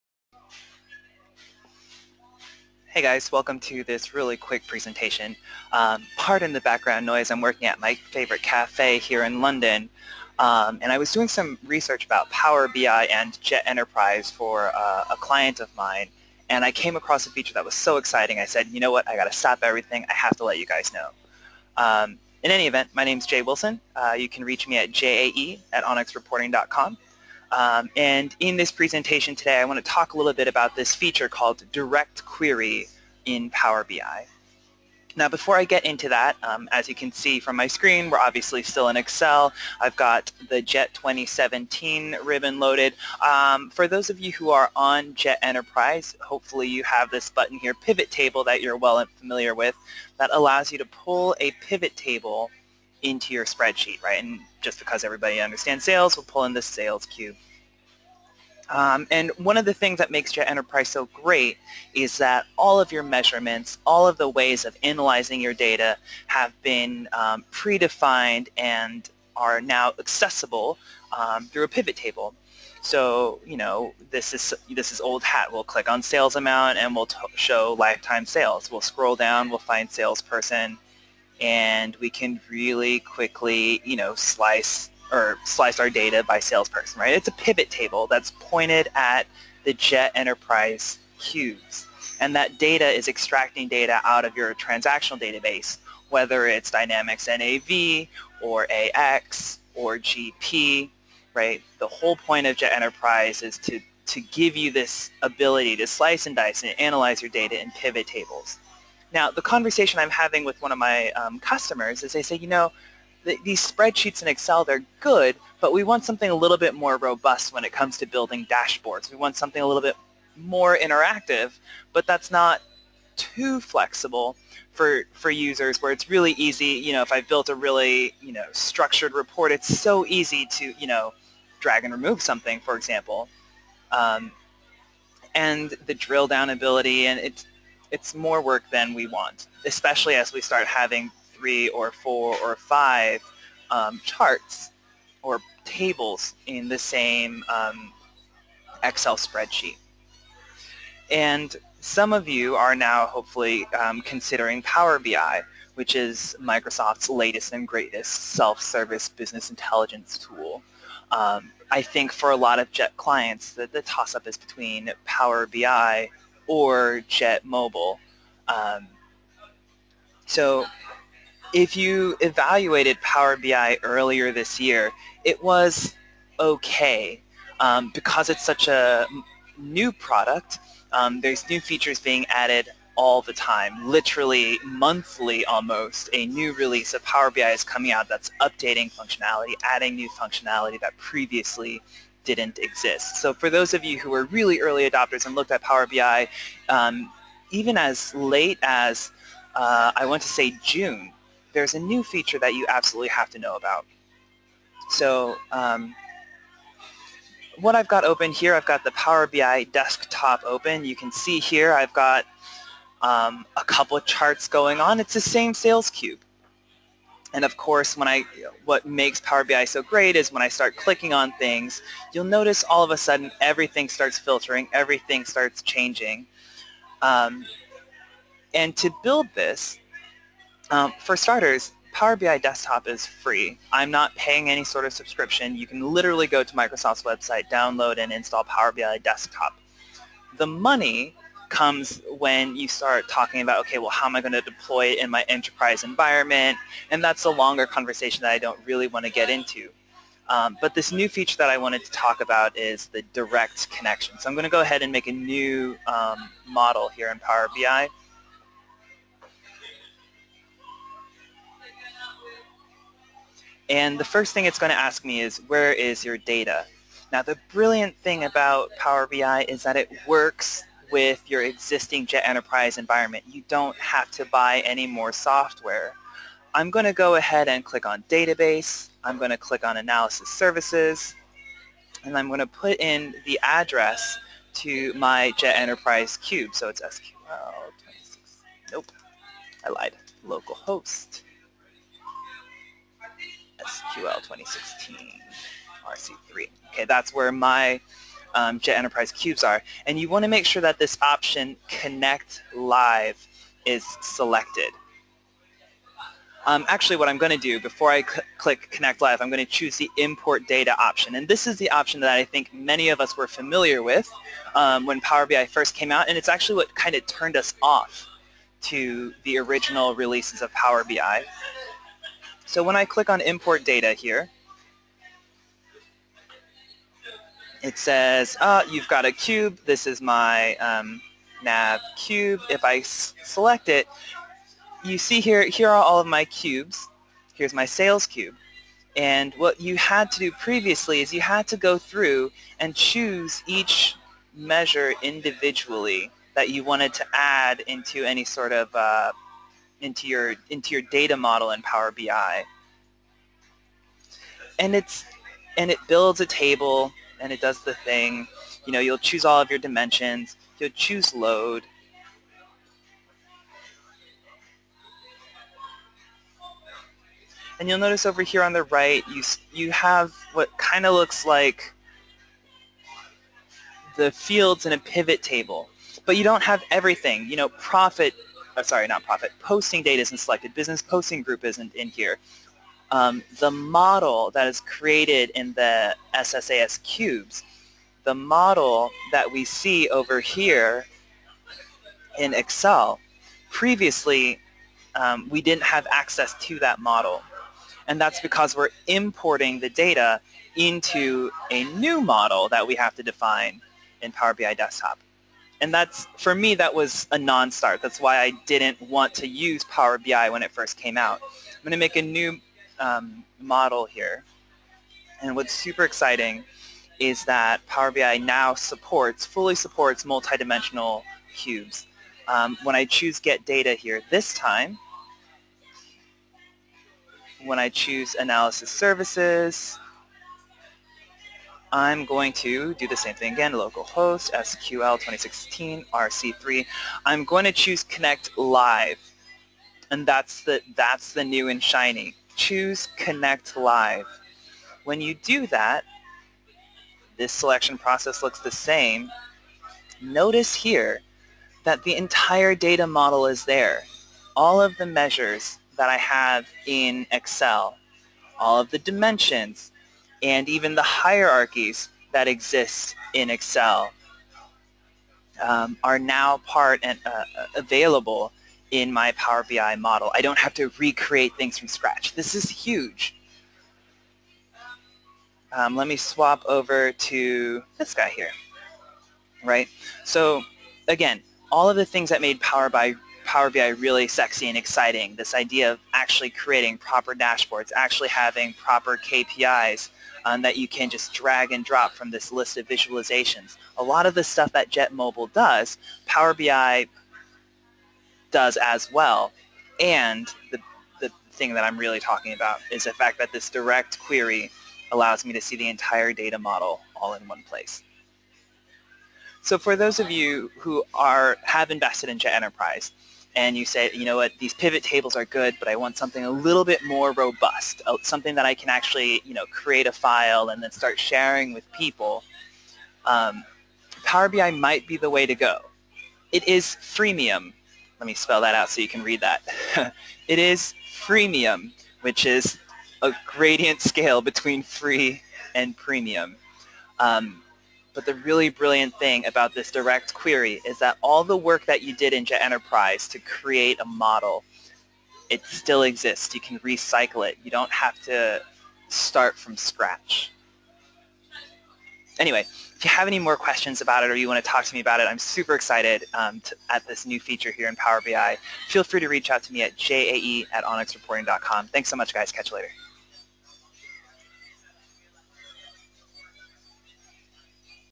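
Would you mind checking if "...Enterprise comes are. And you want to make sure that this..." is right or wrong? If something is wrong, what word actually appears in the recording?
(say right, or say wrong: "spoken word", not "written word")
wrong: "cubes", not "comes".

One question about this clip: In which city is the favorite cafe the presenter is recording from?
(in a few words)
London.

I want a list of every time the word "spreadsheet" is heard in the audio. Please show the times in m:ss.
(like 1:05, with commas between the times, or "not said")
0:53, 1:53, 2:29.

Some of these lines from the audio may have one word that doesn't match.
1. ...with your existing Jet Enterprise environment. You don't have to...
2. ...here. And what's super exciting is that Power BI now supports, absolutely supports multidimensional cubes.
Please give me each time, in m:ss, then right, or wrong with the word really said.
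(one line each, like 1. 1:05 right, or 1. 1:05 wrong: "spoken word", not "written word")
1. 4:30 right
2. 6:53 wrong: "fully", not "absolutely".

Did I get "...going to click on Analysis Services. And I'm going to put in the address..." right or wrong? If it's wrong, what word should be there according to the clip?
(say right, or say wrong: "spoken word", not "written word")
right.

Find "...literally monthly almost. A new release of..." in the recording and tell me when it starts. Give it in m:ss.
3:03.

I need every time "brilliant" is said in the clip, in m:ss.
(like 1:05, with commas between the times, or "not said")
4:27, 8:58.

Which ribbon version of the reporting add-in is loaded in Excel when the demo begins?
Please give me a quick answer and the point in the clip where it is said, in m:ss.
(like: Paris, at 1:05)
JET 2017, at 0:40.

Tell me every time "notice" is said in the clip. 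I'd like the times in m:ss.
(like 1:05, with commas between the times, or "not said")
3:42, 6:07, 7:30.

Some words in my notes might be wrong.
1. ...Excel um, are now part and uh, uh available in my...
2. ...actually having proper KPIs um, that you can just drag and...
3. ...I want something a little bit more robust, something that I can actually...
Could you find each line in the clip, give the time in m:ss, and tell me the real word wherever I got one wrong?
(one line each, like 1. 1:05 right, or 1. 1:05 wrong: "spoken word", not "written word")
1. 7:43 right
2. 8:07 right
3. 8:35 right.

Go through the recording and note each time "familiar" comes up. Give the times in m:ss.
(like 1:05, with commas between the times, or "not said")
0:49, 5:13.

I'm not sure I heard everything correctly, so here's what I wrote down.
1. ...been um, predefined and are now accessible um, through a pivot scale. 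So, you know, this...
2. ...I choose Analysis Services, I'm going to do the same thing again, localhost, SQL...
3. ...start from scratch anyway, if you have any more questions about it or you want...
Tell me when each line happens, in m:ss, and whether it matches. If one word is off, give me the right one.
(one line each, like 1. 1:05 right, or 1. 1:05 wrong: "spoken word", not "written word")
1. 1:06 wrong: "table", not "scale"
2. 7:07 right
3. 9:08 right.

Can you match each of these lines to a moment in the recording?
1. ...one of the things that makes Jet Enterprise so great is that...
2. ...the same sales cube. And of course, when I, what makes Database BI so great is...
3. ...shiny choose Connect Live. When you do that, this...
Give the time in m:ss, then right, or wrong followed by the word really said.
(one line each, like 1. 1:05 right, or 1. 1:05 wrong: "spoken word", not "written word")
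1. 0:59 right
2. 3:35 wrong: "Power", not "Database"
3. 7:21 right.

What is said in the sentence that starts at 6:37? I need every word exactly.
And that's because we're importing the data into a new model that we have to define in Power BI Desktop.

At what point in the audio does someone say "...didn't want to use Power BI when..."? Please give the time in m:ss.
6:48.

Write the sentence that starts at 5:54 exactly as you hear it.
And it's and it builds a table and it does the thing.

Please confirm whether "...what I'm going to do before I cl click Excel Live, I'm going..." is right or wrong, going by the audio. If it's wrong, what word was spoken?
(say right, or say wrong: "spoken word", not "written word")
wrong: "Connect", not "Excel".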